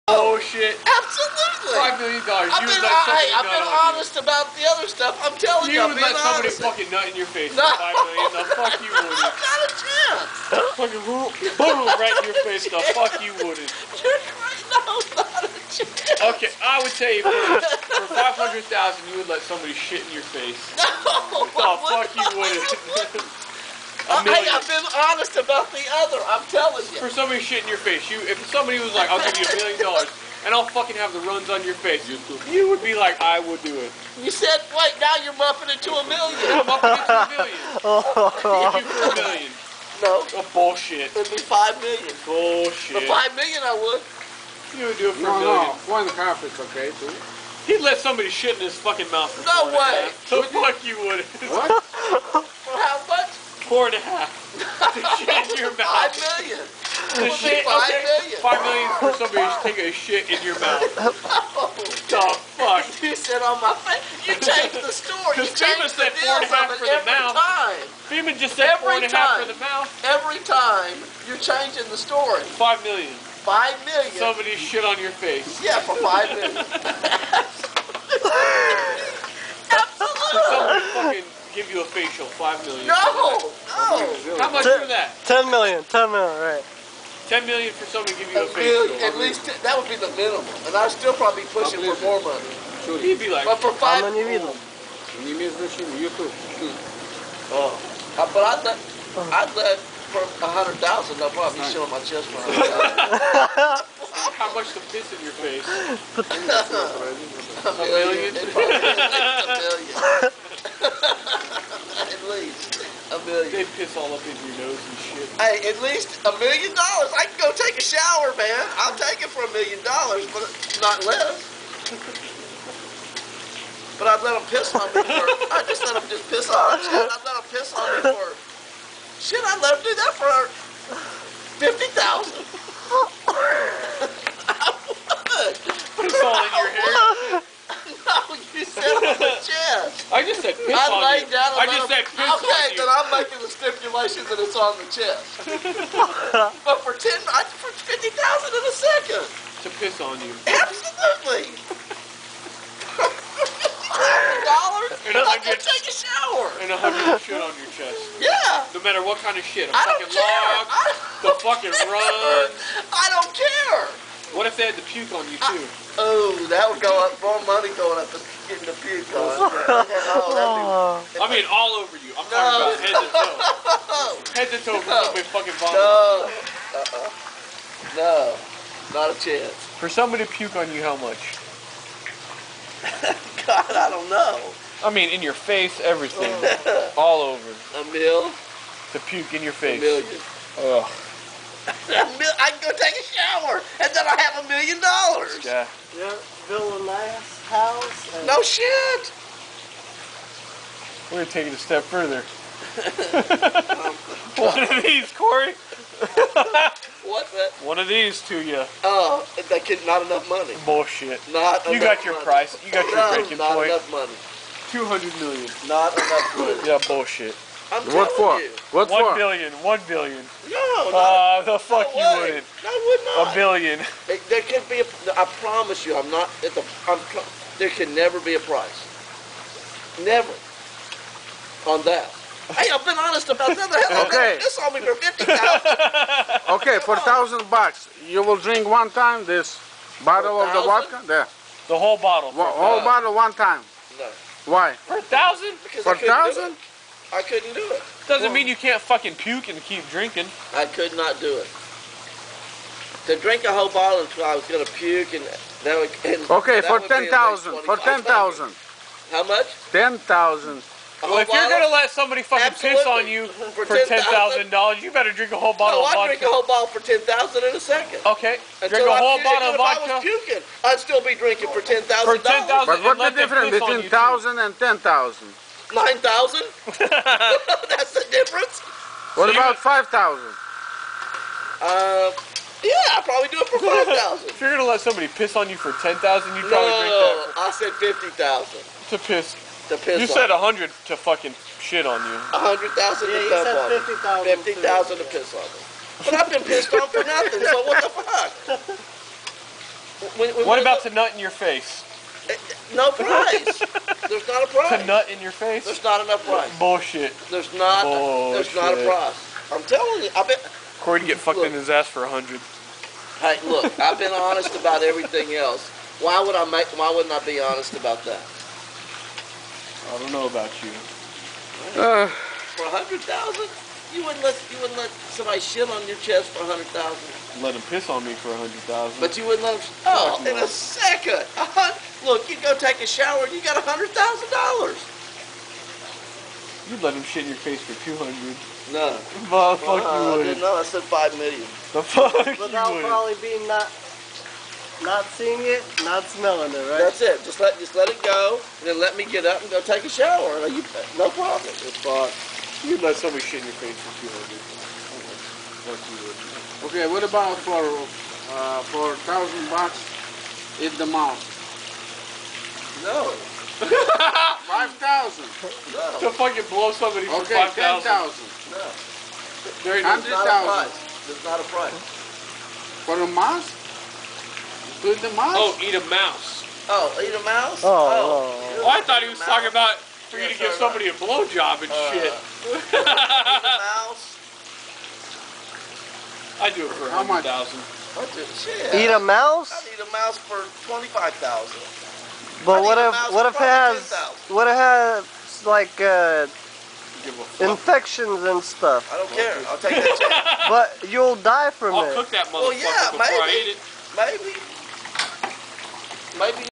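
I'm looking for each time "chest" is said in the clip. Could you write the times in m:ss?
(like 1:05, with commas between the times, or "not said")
1:41, 2:19, 2:24, 2:37, 5:25.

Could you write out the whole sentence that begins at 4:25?
No, I drink a whole bottle for ten thousand in a second.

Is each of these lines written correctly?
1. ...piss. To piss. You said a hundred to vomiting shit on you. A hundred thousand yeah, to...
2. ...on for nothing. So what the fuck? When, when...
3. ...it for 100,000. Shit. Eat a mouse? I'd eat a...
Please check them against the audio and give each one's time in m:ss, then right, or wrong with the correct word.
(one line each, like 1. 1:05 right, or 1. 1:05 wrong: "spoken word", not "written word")
1. 4:48 wrong: "fucking", not "vomiting"
2. 4:56 right
3. 6:26 right.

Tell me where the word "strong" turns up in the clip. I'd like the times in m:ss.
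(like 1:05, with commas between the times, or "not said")
not said.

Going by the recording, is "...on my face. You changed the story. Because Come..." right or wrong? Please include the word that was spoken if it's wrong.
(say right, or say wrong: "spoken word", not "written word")
wrong: "FEMA", not "Come".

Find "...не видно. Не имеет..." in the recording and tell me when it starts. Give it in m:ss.
1:34.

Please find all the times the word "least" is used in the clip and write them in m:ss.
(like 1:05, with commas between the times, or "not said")
1:29, 1:55.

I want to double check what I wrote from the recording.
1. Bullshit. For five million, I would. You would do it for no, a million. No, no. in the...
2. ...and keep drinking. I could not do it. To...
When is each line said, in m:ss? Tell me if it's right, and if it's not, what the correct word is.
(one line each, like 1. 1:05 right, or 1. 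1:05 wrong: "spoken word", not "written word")
1. 0:42 right
2. 4:09 right.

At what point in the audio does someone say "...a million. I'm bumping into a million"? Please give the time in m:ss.
0:35.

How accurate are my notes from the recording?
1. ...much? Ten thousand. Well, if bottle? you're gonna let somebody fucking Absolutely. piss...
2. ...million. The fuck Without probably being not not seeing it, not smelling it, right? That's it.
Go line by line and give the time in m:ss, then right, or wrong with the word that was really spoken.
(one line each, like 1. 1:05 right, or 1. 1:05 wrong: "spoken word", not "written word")
1. 4:19 right
2. 5:41 right.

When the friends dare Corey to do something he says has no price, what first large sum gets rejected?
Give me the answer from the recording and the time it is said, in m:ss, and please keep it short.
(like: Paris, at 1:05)
200 million, at 3:34.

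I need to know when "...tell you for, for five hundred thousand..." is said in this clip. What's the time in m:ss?
0:16.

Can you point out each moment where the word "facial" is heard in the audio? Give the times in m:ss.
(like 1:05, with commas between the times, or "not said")
1:22, 1:28.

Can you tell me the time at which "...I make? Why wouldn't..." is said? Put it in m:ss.
5:16.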